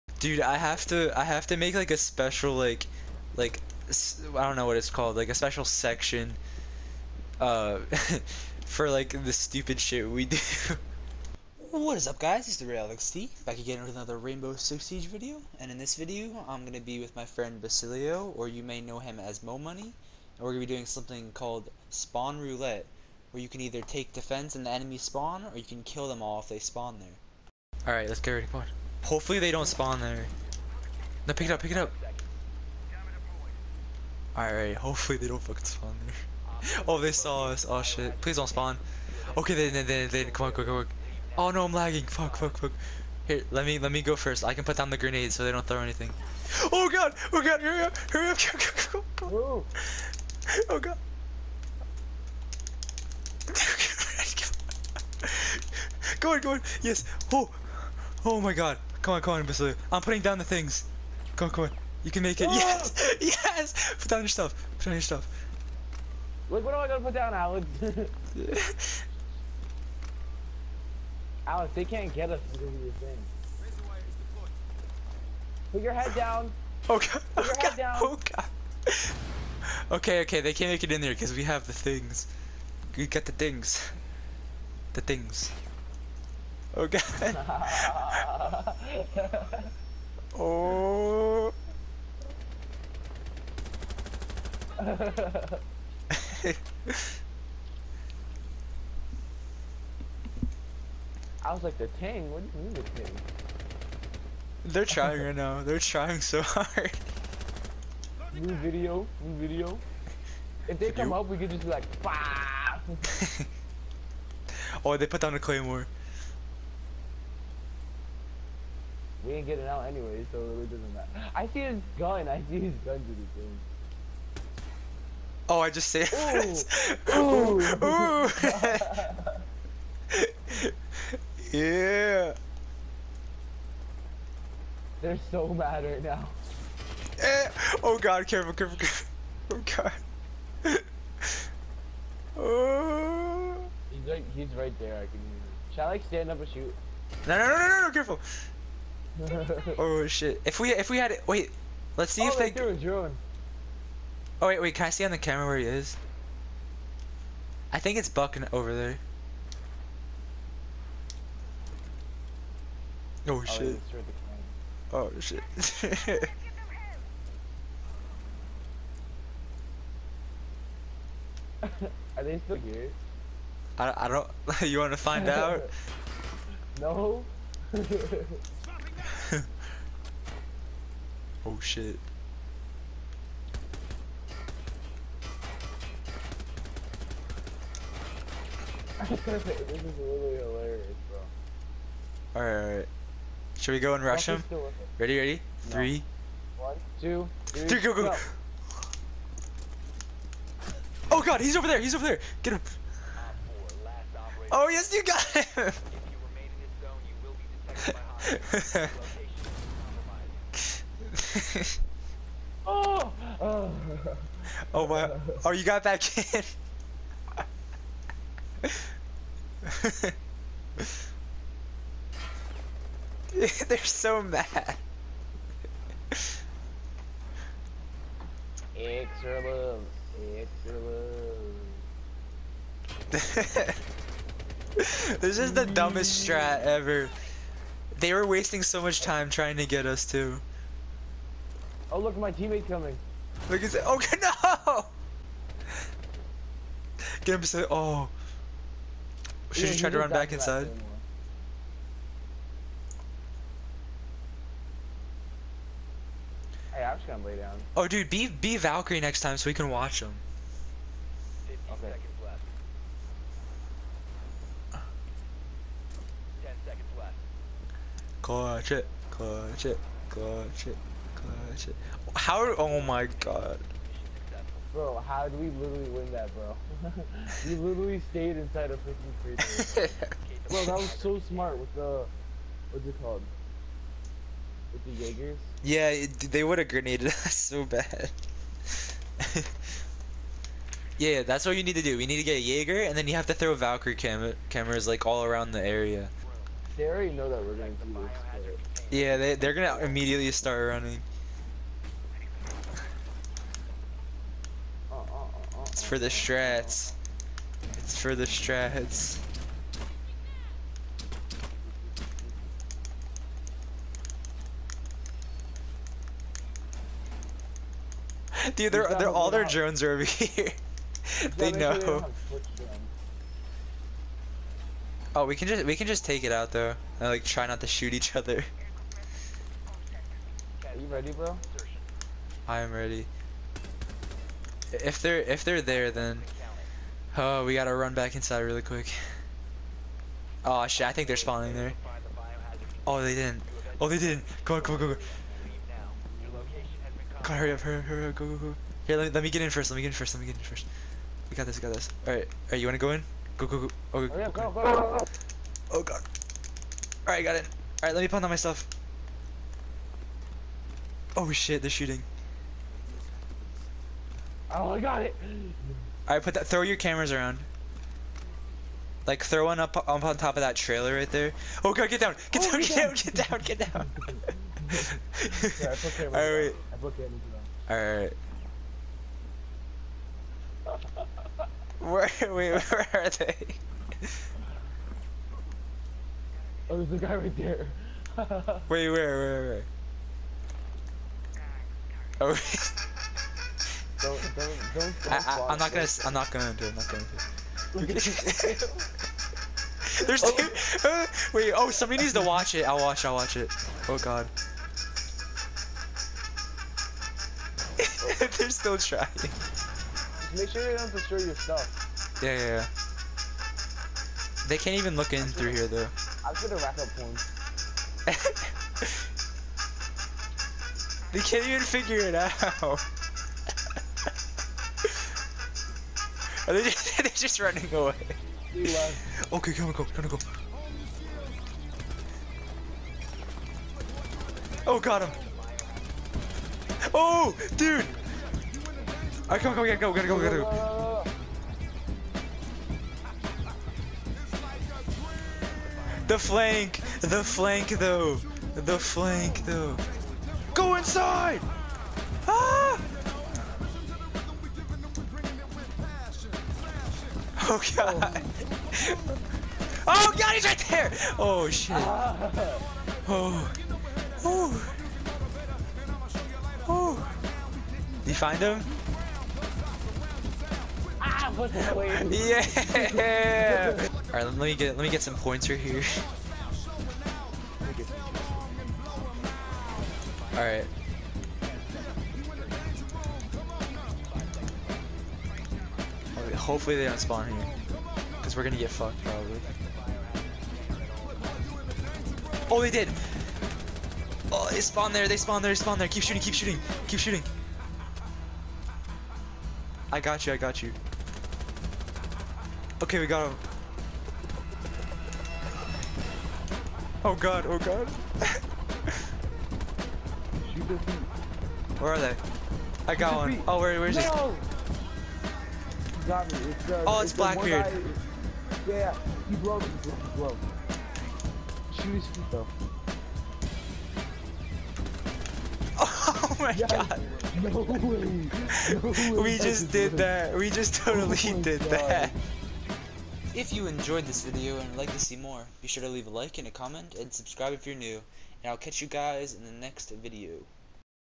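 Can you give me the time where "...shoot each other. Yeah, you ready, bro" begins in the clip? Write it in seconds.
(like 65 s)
327 s.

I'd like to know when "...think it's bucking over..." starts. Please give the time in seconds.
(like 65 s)
157 s.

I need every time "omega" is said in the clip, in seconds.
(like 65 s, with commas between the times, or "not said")
not said.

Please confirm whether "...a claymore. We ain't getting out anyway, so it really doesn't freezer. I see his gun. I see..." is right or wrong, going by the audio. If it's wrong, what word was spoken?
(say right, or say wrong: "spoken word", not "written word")
wrong: "matter", not "freezer".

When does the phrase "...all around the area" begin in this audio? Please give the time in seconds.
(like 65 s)
295 s.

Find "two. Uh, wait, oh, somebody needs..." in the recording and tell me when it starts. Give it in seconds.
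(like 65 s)
400 s.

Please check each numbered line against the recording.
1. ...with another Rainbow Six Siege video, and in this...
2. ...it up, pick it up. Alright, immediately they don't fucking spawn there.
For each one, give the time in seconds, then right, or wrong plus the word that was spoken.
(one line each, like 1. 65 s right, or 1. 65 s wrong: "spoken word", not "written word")
1. 13 s right
2. 31 s wrong: "hopefully", not "immediately".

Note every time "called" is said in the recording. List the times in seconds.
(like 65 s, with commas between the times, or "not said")
4 s, 21 s, 283 s.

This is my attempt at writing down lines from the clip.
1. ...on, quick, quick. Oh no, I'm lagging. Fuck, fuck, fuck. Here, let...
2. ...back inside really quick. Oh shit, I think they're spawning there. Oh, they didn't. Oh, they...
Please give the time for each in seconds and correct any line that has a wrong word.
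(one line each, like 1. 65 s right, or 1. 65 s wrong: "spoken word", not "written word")
1. 40 s right
2. 337 s right.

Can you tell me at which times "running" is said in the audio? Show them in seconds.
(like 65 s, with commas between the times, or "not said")
300 s, 427 s.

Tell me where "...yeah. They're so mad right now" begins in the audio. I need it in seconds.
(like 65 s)
131 s.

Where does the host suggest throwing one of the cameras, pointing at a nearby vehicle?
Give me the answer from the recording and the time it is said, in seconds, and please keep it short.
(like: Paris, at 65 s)
on top of that trailer, at 369 s.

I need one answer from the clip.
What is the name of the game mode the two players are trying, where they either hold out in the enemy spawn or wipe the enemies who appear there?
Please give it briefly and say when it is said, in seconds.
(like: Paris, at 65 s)
Spawn Roulette, at 21 s.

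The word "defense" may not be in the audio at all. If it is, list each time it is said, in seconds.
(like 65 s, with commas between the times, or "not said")
24 s.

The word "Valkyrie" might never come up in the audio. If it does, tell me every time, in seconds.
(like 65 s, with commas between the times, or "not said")
258 s, 293 s.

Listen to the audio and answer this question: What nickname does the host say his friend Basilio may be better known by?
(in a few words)
Mo Money.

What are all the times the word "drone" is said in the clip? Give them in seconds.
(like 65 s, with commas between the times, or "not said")
152 s, 319 s.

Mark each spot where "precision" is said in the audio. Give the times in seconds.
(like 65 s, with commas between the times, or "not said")
not said.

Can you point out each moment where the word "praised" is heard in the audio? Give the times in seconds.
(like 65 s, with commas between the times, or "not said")
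not said.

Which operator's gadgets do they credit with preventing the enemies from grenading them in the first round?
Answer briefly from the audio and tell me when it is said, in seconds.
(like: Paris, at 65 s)
Jaeger, at 285 s.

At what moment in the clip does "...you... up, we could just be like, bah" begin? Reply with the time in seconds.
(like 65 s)
111 s.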